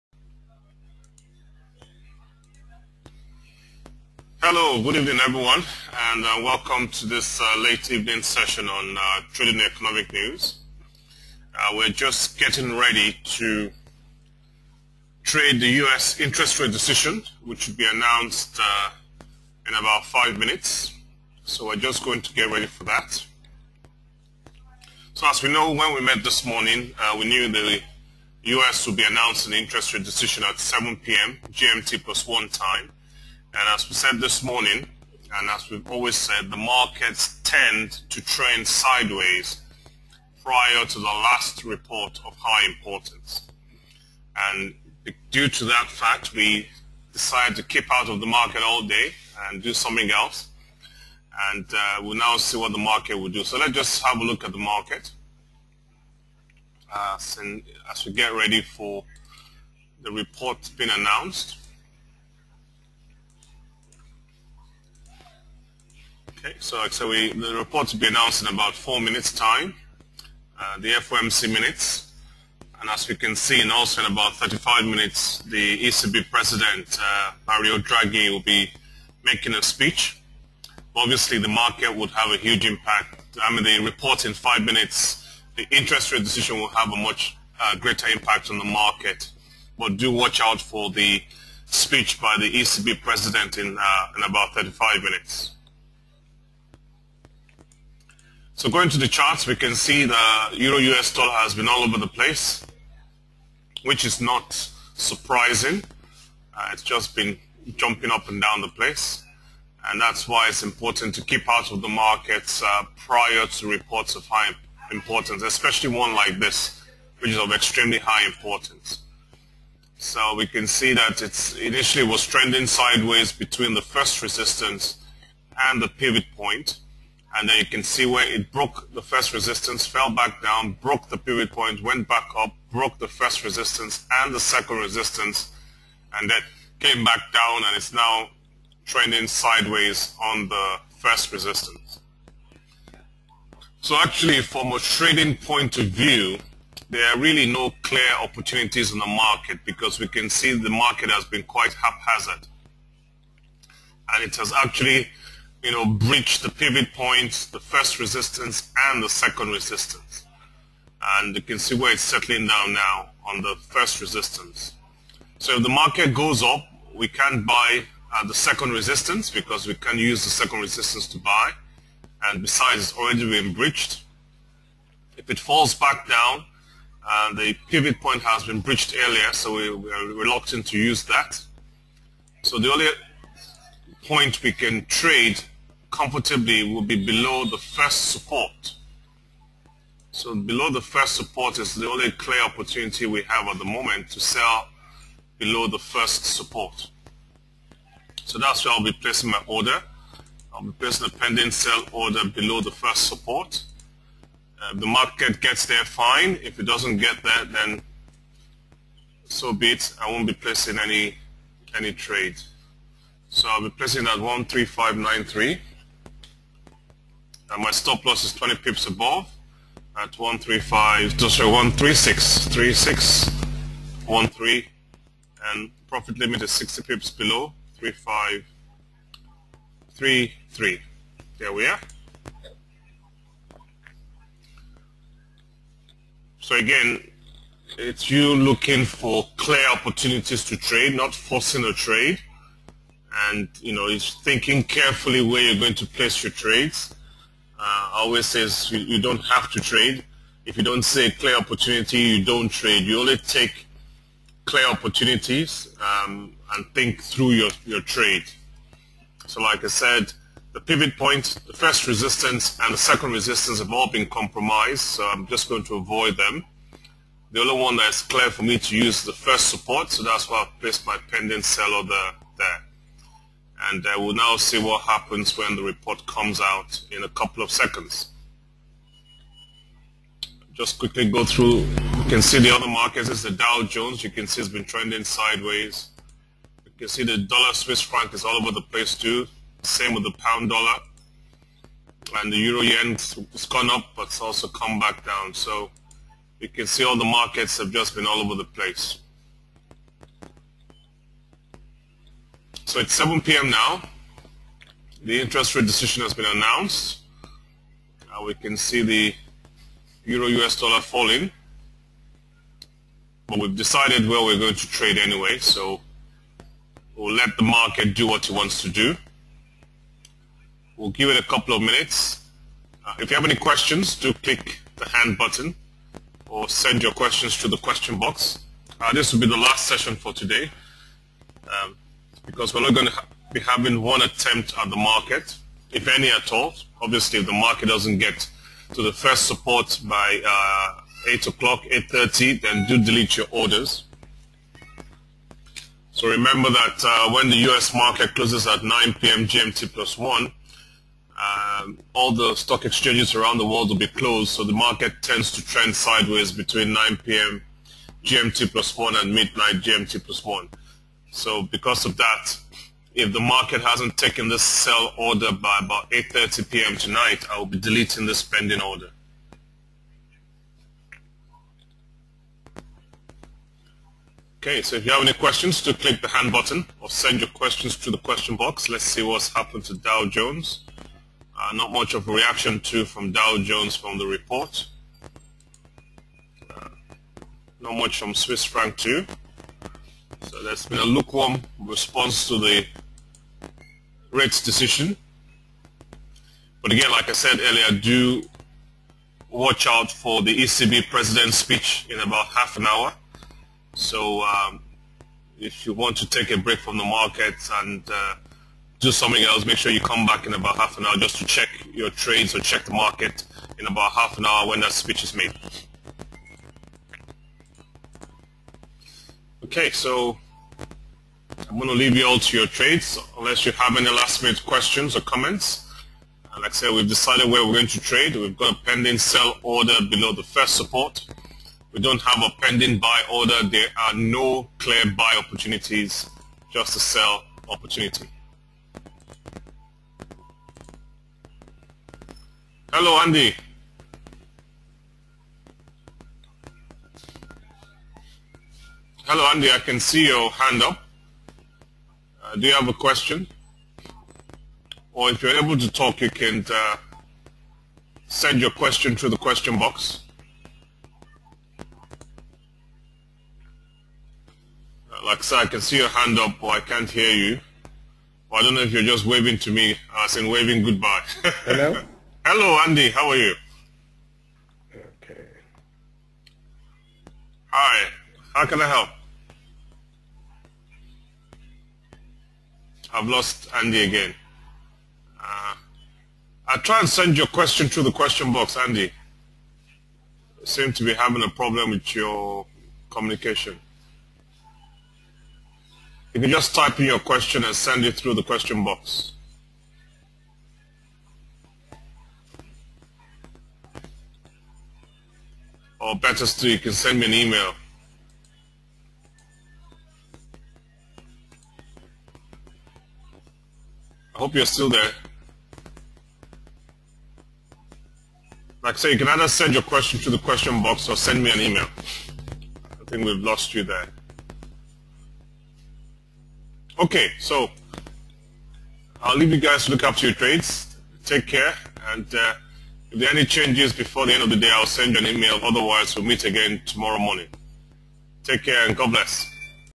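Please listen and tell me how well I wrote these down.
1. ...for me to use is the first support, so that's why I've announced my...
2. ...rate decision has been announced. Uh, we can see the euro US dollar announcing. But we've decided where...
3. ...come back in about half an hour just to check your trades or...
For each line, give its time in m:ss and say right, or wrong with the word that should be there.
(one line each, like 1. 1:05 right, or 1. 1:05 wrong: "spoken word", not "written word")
1. 4:28 wrong: "placed", not "announced"
2. 5:05 wrong: "falling", not "announcing"
3. 6:49 right.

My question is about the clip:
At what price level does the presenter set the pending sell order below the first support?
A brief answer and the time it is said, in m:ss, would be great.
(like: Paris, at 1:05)
13593, at 3:34.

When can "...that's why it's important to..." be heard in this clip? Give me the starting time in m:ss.
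1:49.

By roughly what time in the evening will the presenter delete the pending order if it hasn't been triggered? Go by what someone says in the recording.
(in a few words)
8.30 p.m.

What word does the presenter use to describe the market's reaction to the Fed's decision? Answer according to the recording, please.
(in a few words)
lukewarm.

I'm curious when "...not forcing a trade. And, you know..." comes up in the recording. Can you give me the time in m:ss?
4:00.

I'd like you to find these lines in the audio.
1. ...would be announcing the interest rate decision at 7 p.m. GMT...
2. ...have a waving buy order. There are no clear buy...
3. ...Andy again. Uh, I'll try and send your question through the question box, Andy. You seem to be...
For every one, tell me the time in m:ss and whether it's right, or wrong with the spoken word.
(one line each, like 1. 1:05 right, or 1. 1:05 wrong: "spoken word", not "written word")
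1. 0:28 right
2. 7:12 wrong: "pending", not "waving"
3. 8:03 right.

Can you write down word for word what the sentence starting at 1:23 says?
I mean, the report in five minutes, the interest rate decision will have a much uh, greater impact on the market.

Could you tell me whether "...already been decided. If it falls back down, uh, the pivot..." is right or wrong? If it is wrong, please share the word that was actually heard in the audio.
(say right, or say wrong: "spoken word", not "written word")
wrong: "breached", not "decided".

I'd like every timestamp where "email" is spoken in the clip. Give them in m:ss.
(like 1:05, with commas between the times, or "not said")
8:27, 8:41, 8:55.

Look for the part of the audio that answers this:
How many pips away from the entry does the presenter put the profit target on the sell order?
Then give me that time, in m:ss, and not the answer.
3:46.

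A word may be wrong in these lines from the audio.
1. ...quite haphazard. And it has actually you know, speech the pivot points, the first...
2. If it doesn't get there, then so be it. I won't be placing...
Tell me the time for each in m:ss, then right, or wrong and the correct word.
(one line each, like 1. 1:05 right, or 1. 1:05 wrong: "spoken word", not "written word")
1. 2:31 wrong: "breach", not "speech"
2. 3:26 right.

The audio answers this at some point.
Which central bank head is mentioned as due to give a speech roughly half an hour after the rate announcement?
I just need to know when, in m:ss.
1:17.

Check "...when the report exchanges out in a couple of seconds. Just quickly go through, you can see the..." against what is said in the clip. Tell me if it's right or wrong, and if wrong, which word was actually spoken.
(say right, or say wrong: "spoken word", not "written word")
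wrong: "comes", not "exchanges".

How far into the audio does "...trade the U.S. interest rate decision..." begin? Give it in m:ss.
0:15.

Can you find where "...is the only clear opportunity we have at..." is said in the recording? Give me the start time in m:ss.
3:11.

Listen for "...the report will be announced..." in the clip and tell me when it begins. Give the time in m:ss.
1:07.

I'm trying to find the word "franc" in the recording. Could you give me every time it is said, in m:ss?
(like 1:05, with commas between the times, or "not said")
4:47, 6:28.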